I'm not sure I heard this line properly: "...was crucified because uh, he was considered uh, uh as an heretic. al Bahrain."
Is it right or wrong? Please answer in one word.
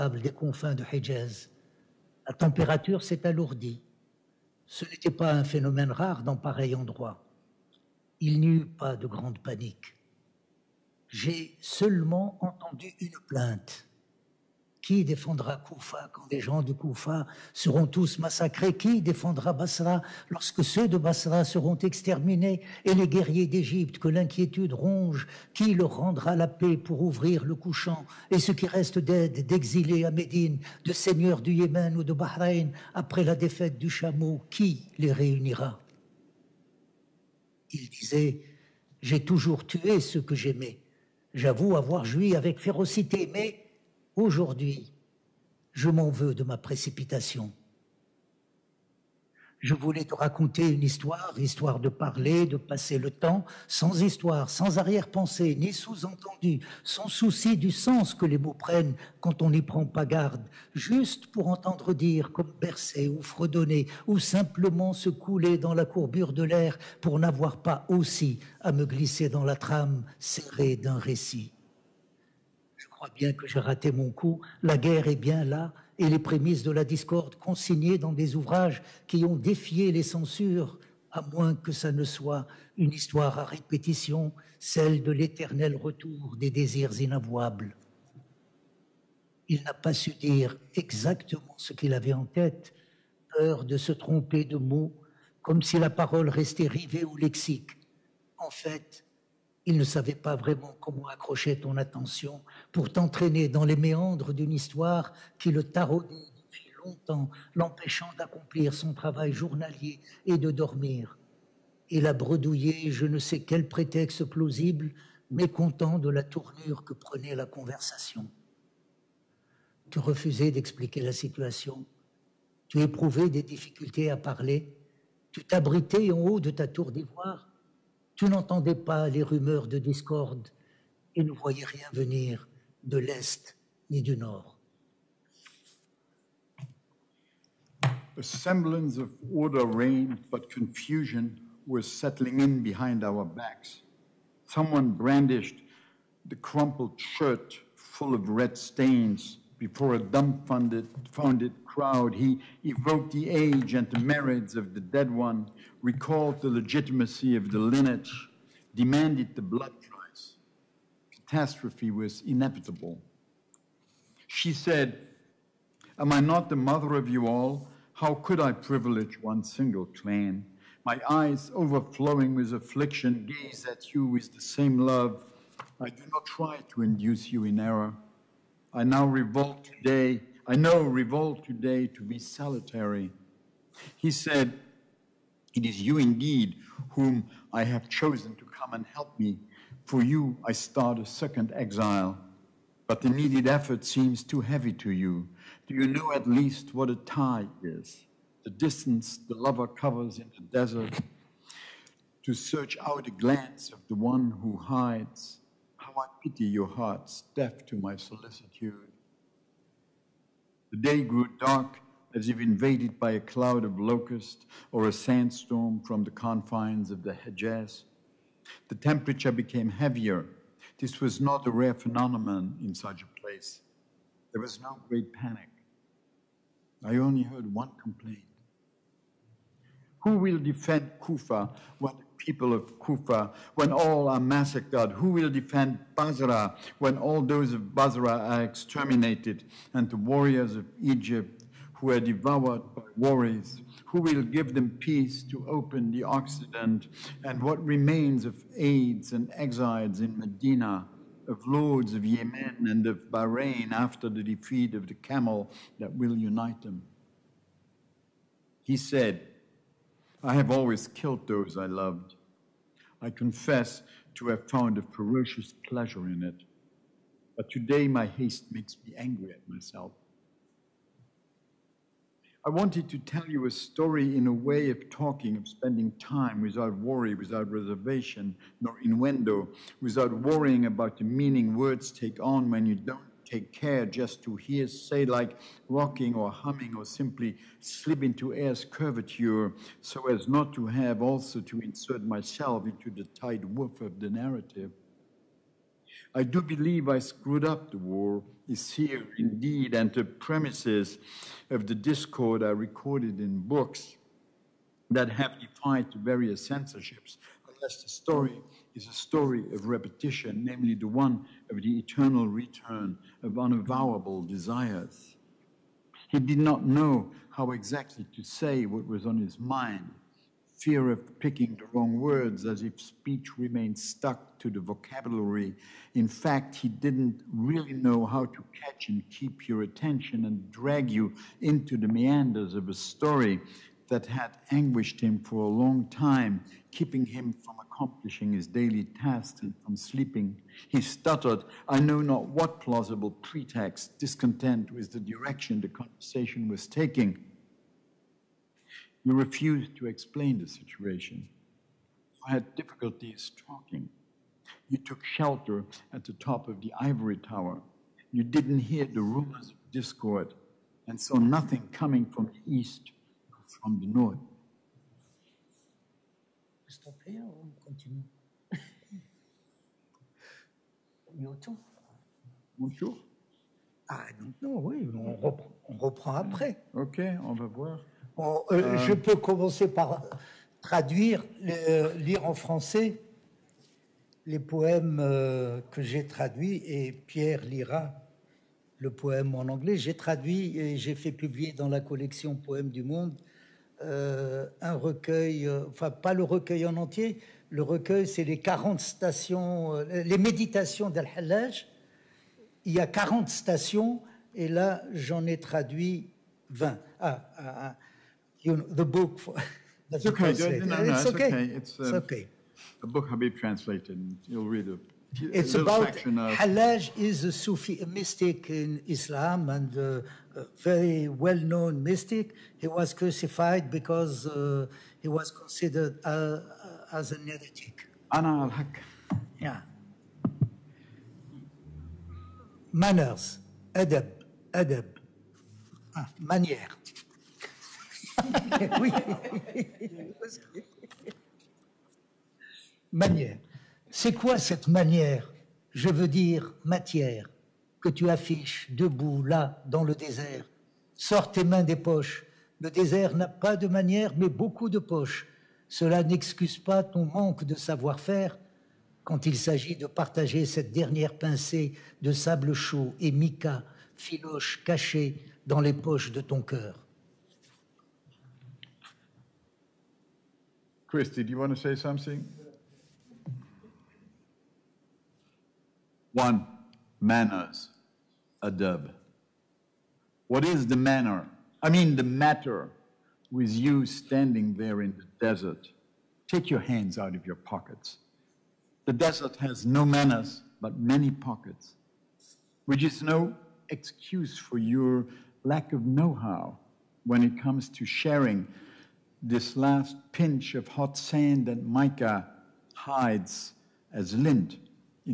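wrong.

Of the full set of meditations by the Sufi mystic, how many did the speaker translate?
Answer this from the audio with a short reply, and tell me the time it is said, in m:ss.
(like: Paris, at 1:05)
20, at 6:46.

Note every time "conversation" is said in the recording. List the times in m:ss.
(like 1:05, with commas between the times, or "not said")
1:57, 5:45.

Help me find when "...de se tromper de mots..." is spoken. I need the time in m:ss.
1:33.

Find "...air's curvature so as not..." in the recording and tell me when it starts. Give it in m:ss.
4:48.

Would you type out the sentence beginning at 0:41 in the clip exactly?
J'avoue avoir joui avec férocité, mais Aujourd'hui, je m'en veux de ma précipitation.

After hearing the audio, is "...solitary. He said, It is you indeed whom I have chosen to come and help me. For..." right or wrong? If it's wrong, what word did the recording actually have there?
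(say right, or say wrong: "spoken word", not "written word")
right.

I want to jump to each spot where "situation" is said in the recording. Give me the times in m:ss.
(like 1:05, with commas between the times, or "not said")
2:01, 5:50.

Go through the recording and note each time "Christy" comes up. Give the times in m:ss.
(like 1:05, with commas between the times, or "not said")
7:50.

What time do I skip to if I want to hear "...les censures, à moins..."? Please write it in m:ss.
1:19.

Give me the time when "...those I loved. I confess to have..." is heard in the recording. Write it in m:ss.
4:21.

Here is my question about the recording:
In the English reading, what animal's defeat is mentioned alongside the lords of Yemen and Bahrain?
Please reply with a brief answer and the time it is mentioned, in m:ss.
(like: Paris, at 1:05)
camel, at 4:14.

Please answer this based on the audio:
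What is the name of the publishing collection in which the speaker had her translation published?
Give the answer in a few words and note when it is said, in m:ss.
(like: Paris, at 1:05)
Poèmes du Monde, at 6:32.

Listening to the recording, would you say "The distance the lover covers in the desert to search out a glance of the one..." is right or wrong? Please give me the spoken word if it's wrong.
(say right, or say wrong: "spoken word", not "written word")
right.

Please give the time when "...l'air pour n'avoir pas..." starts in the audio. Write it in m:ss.
1:06.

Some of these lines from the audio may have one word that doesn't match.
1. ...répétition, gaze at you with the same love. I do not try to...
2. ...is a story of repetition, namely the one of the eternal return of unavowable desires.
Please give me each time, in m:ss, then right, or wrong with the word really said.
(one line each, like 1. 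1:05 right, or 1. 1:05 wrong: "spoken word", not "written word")
1. 2:52 wrong: "affliction", not "répétition"
2. 5:08 right.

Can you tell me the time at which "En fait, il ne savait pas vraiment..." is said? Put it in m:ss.
1:38.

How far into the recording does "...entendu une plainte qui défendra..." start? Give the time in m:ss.
0:12.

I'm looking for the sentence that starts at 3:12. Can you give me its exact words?
But the needed effort seems too heavy to you.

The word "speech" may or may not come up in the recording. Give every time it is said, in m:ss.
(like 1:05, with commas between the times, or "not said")
5:22.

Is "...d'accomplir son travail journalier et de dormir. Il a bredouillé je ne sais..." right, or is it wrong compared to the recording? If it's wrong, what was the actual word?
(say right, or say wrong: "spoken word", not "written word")
right.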